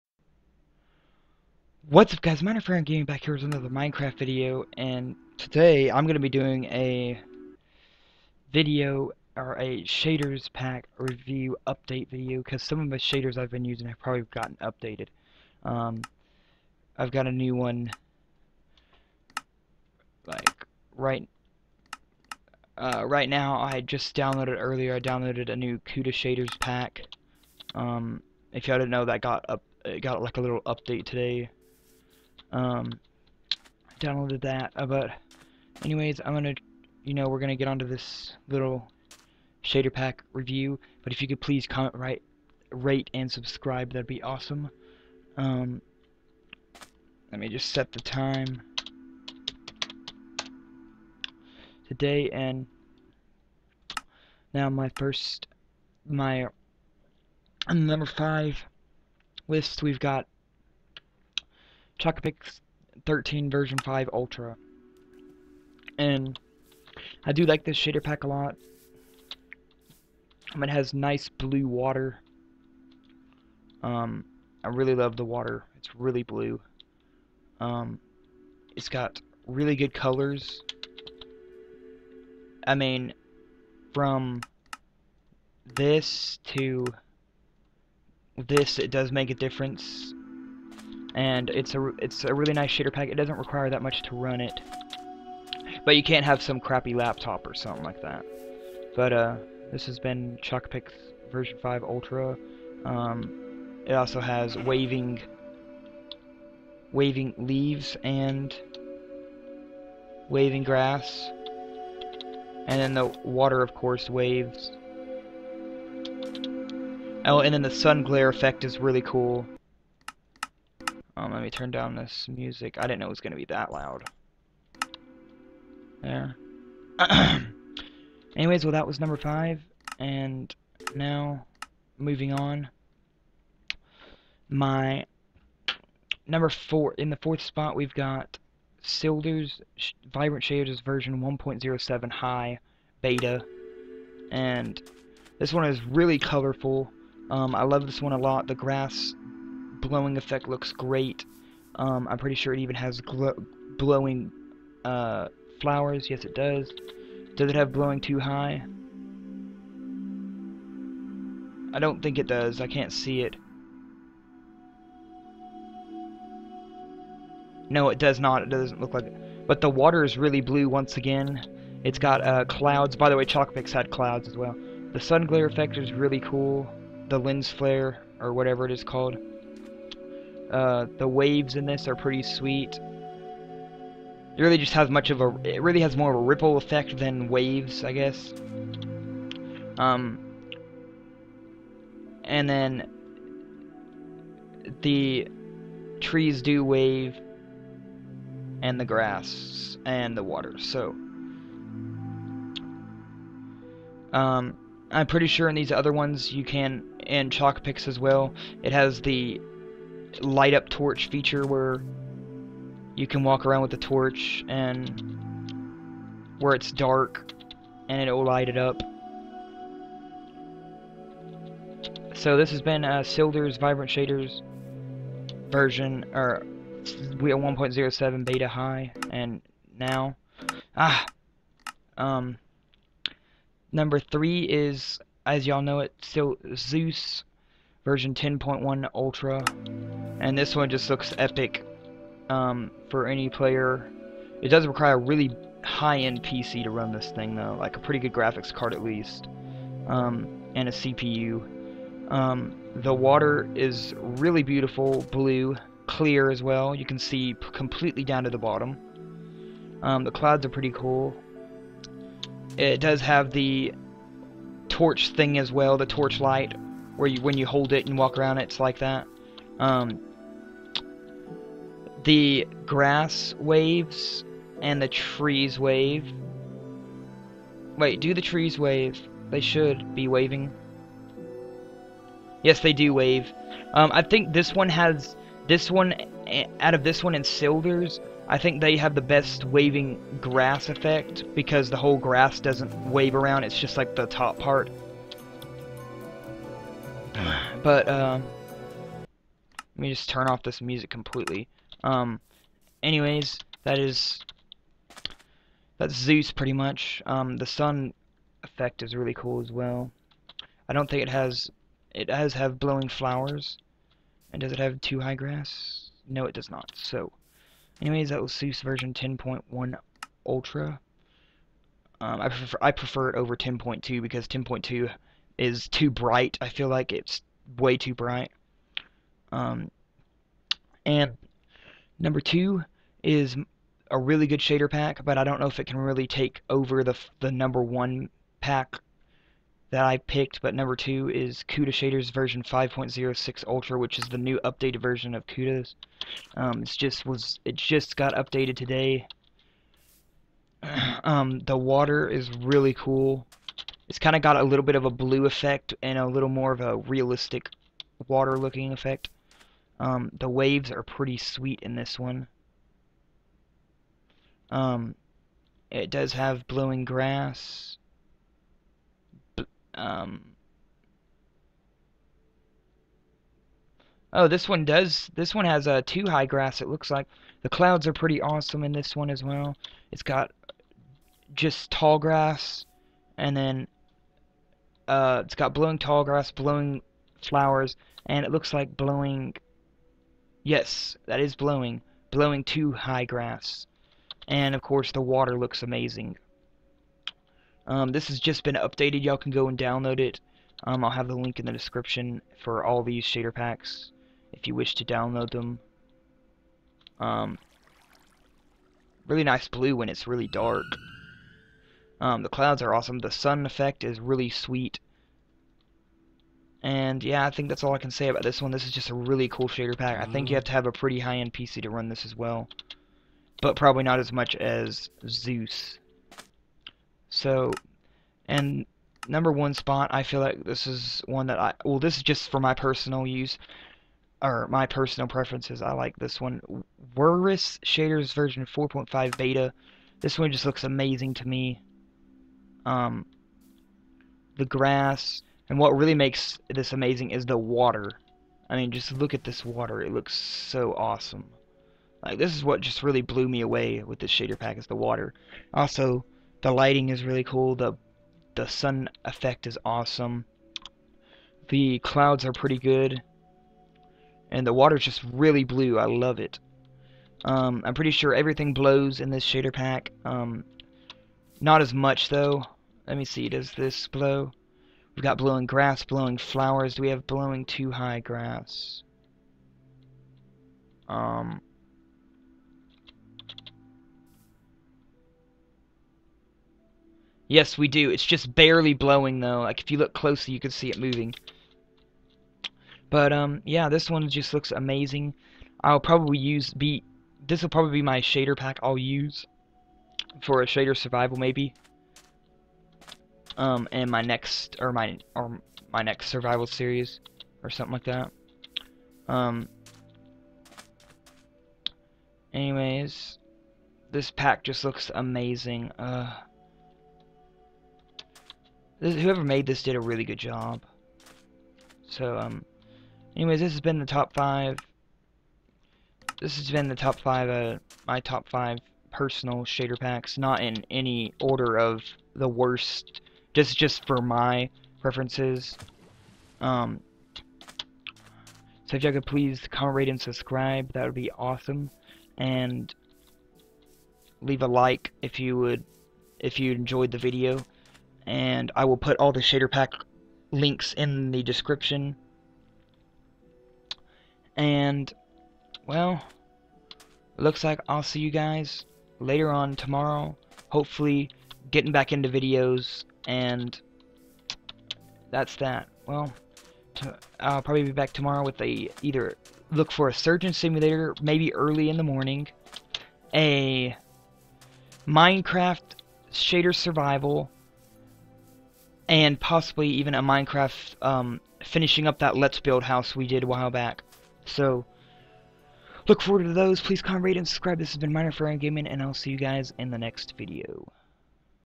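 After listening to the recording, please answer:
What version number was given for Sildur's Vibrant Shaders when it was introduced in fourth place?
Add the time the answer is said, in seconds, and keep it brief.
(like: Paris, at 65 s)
1.07, at 140 s.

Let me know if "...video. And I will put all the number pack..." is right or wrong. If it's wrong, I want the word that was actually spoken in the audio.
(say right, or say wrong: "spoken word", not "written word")
wrong: "shader", not "number".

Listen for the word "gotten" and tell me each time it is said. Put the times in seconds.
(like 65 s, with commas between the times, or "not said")
14 s.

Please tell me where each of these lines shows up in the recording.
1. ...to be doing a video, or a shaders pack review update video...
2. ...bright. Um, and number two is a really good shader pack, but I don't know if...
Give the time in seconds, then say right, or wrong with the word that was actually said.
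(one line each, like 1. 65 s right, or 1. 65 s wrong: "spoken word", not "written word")
1. 6 s right
2. 327 s right.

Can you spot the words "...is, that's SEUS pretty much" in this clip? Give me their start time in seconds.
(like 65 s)
303 s.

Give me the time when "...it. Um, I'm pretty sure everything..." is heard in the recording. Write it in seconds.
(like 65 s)
466 s.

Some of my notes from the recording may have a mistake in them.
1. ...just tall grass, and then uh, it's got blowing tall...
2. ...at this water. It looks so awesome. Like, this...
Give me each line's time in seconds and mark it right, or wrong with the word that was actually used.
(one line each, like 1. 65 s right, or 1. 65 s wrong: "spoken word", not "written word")
1. 381 s right
2. 449 s right.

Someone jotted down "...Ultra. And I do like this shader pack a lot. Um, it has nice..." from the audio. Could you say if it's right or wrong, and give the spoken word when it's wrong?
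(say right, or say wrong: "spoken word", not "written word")
right.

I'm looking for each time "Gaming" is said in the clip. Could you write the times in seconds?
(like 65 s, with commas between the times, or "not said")
2 s, 588 s.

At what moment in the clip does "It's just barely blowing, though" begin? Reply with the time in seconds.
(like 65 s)
487 s.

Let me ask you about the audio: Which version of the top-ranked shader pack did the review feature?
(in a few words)
4.5 beta.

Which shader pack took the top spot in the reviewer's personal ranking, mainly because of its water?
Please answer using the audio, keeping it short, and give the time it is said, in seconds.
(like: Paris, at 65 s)
Werrus Shaders, at 436 s.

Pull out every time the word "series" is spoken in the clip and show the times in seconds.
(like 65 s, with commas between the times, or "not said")
506 s.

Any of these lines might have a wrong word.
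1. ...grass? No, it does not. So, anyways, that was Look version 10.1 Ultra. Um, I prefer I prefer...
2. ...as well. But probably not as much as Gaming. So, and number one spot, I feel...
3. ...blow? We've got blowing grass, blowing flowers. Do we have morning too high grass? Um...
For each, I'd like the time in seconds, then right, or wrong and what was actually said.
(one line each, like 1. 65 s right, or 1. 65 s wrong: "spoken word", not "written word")
1. 315 s wrong: "SEUS", not "Look"
2. 422 s wrong: "SEUS", not "Gaming"
3. 473 s wrong: "blowing", not "morning".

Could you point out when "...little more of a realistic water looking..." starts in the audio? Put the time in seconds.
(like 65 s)
356 s.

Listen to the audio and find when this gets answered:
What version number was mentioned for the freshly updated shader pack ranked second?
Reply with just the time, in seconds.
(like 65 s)
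342 s.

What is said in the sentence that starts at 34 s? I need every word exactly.
Uh, but anyways, I'm gonna, you know, we're gonna get onto this little shader pack review.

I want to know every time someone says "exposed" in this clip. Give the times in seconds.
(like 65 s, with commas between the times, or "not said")
not said.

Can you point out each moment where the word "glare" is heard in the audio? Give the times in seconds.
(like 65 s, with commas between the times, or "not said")
118 s, 175 s.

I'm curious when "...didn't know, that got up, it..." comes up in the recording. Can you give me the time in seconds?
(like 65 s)
28 s.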